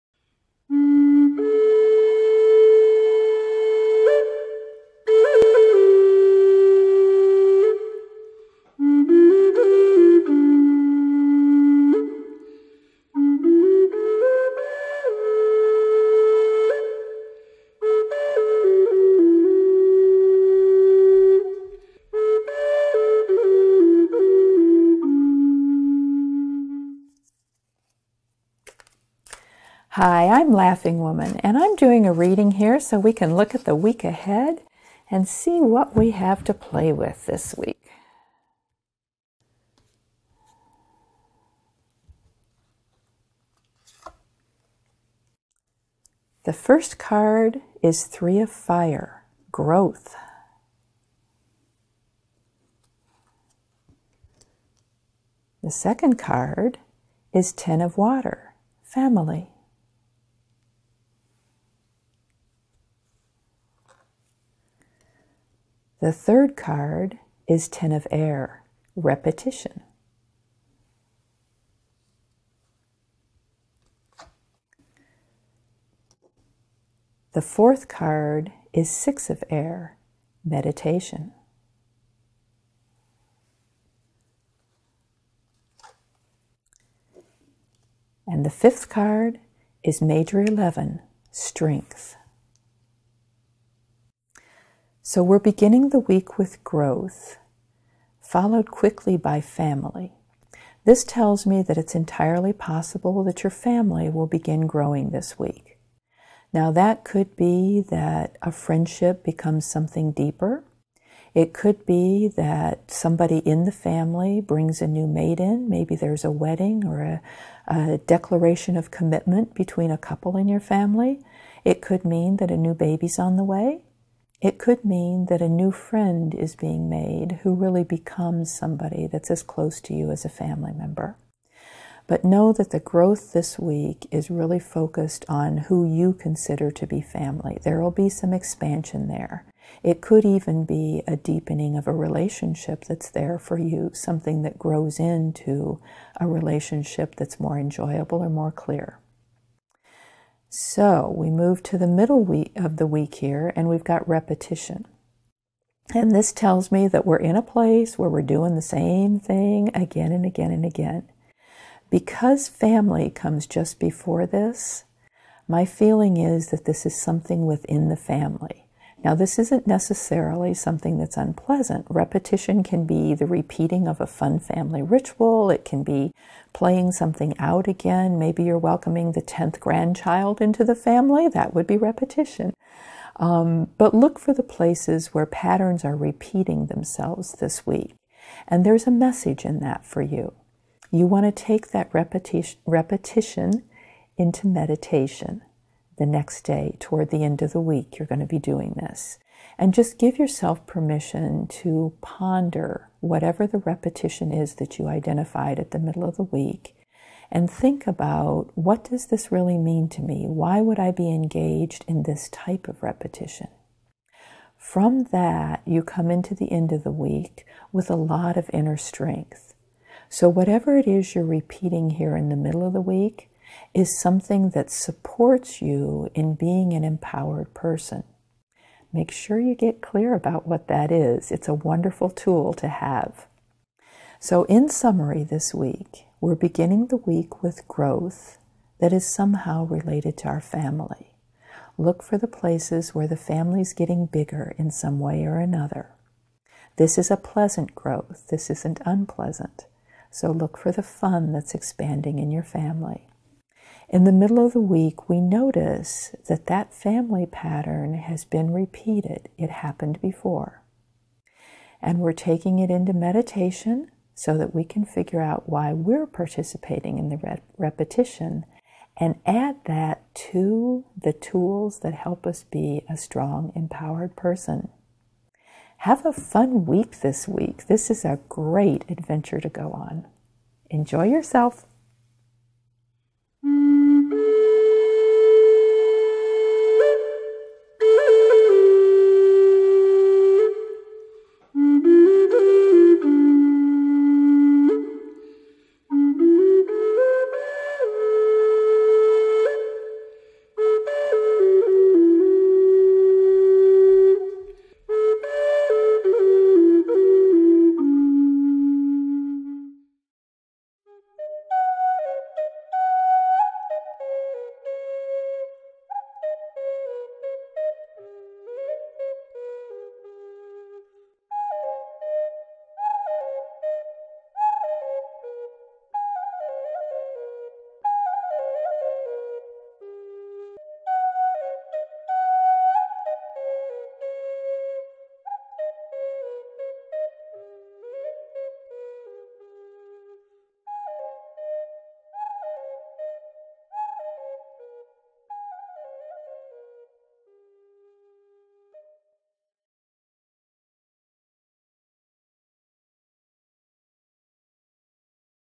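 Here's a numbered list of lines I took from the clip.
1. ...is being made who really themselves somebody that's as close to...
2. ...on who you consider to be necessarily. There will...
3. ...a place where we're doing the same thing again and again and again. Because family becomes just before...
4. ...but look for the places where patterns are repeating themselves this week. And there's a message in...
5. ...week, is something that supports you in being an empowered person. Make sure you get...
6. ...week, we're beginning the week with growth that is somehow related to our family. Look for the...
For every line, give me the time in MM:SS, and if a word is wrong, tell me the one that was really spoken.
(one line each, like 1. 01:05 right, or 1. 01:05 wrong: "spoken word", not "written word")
1. 02:06 wrong: "becomes", not "themselves"
2. 02:15 wrong: "family", not "necessarily"
3. 02:37 wrong: "comes", not "becomes"
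4. 03:03 right
5. 03:42 right
6. 03:55 right.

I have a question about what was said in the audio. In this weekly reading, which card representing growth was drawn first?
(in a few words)
Three of Fire.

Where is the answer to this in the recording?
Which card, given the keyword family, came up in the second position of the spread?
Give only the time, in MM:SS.
00:57.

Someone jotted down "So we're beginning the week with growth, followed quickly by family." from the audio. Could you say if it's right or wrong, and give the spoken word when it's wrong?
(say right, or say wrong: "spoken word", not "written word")
right.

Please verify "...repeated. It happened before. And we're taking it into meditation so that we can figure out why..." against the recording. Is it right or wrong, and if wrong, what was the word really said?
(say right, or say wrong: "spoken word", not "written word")
right.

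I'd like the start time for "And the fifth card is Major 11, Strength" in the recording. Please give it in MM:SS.
01:28.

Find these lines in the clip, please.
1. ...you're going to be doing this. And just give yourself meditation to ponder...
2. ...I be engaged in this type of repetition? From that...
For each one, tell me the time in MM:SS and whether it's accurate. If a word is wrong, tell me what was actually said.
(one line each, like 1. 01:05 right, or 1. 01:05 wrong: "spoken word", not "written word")
1. 03:17 wrong: "permission", not "meditation"
2. 03:30 right.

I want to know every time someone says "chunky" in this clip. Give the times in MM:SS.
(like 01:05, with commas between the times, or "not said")
not said.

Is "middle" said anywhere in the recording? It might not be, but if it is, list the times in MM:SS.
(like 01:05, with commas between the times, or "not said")
02:31, 03:25, 03:42, 04:14.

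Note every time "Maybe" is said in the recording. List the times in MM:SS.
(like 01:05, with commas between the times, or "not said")
01:55, 02:58.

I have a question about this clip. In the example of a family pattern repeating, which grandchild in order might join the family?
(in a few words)
10th.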